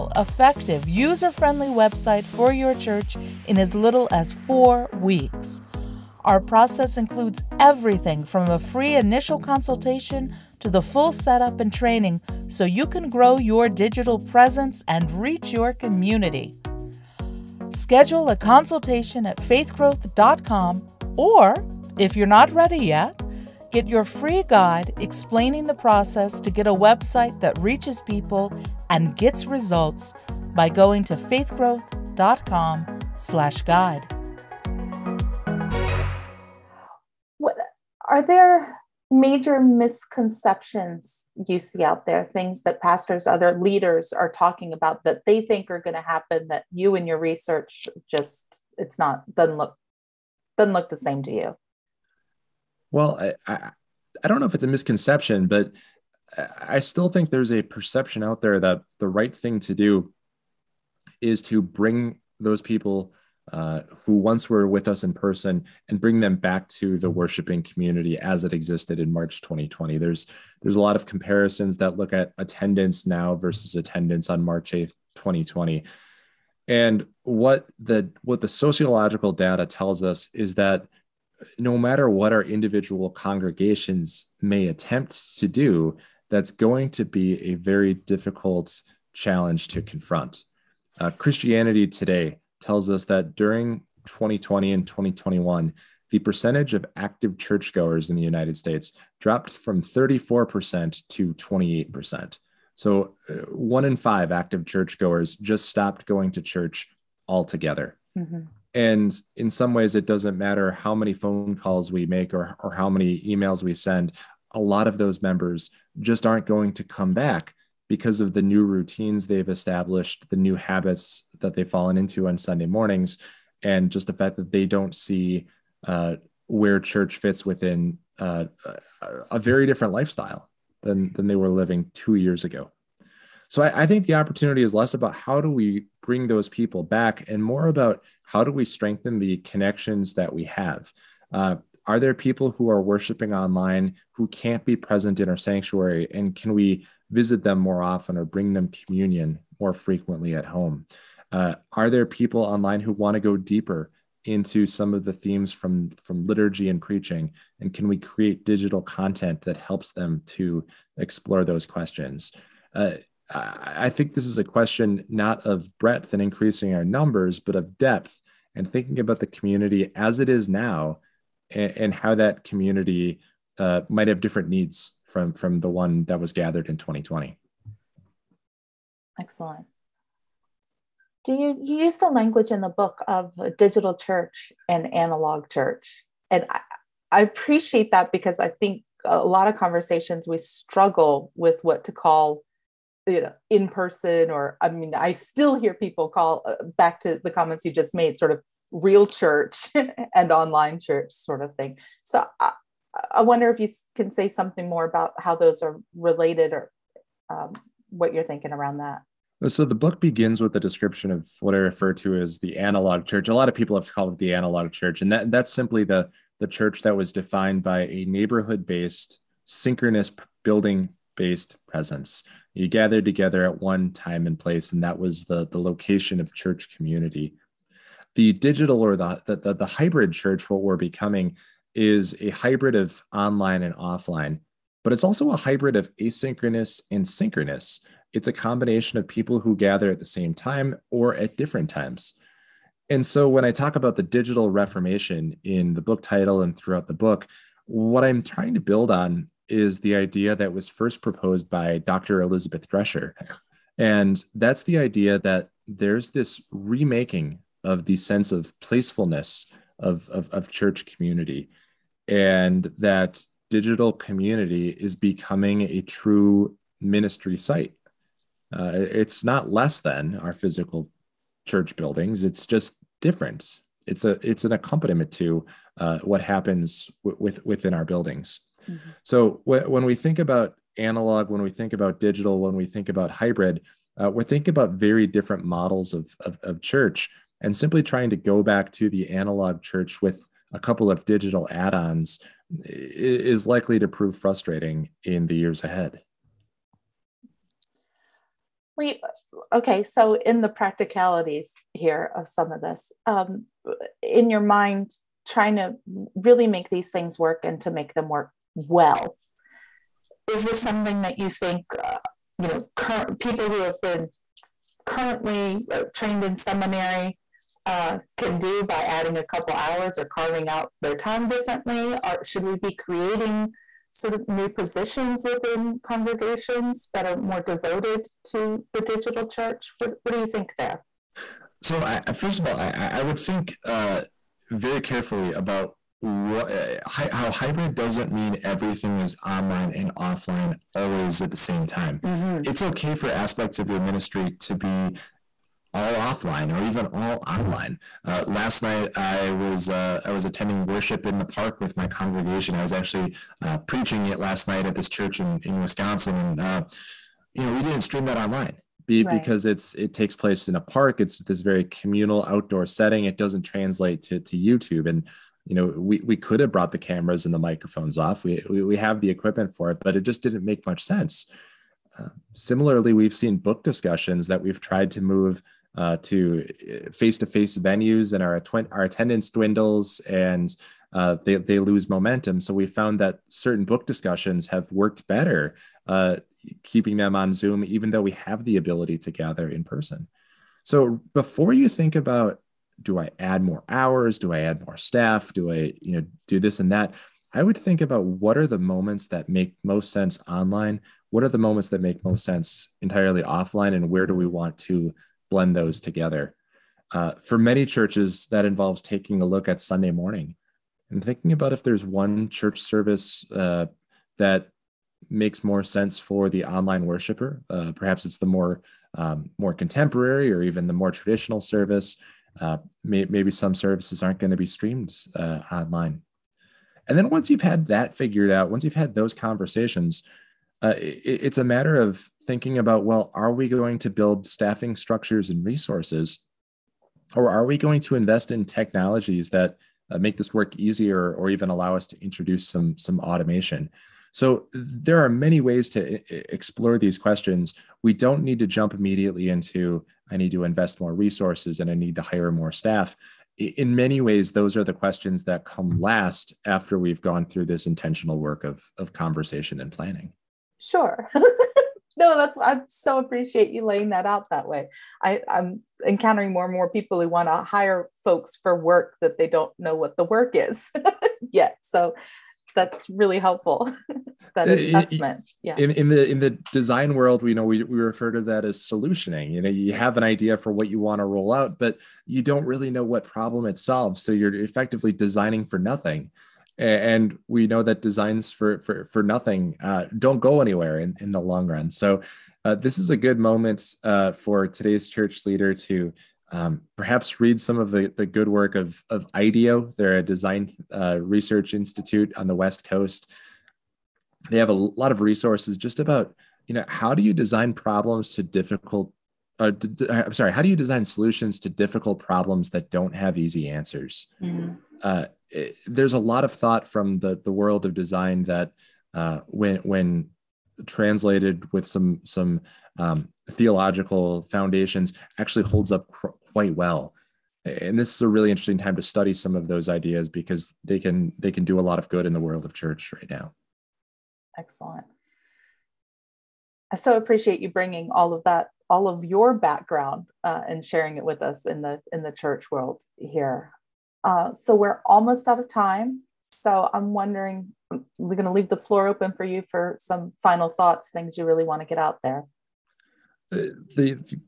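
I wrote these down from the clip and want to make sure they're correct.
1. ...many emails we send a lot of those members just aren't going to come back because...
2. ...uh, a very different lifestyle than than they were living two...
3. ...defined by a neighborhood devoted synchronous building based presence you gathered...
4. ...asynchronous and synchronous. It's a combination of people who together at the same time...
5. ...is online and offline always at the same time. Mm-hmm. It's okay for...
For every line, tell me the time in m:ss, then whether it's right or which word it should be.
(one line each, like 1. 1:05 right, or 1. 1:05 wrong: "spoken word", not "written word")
1. 1:52 right
2. 2:08 right
3. 3:37 wrong: "based", not "devoted"
4. 3:55 wrong: "gather", not "together"
5. 5:38 right.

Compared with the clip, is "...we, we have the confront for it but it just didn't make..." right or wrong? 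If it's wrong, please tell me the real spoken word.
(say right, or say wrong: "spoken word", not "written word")
wrong: "equipment", not "confront".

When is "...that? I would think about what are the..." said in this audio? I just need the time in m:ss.
6:36.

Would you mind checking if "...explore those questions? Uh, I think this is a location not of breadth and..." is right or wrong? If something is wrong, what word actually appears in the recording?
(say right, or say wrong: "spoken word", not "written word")
wrong: "question", not "location".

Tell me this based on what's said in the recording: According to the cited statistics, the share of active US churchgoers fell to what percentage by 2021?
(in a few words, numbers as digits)
28%.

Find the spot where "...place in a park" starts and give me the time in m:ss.
6:00.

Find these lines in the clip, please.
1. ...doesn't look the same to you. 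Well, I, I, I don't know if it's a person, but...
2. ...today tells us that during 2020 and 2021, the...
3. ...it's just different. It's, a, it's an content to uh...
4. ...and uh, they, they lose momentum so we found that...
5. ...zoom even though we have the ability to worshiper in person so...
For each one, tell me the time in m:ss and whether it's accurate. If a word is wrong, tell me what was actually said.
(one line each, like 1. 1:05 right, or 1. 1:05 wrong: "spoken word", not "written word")
1. 0:50 wrong: "misconception", not "person"
2. 1:31 right
3. 4:32 wrong: "accompaniment", not "content"
4. 6:20 right
5. 6:27 wrong: "gather", not "worshiper".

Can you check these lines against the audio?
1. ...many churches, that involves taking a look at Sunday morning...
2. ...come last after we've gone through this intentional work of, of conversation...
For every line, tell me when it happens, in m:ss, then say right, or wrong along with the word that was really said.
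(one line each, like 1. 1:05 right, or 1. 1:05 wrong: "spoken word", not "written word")
1. 6:47 right
2. 7:35 right.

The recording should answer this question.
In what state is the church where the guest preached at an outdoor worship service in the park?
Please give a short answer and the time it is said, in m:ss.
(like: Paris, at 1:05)
Wisconsin, at 5:55.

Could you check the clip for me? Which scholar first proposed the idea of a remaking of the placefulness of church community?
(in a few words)
Elizabeth Drescher.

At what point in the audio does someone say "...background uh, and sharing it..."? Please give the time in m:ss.
8:59.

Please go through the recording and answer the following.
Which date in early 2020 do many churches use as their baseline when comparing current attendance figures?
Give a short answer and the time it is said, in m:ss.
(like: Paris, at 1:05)
March 8, 2020, at 1:14.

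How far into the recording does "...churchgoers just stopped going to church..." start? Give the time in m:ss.
1:44.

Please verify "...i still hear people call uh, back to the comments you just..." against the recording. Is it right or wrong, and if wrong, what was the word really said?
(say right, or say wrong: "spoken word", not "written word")
right.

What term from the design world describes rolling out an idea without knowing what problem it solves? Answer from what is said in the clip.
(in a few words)
solutioning.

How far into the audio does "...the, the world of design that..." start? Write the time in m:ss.
8:36.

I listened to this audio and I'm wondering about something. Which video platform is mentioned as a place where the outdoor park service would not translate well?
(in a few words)
YouTube.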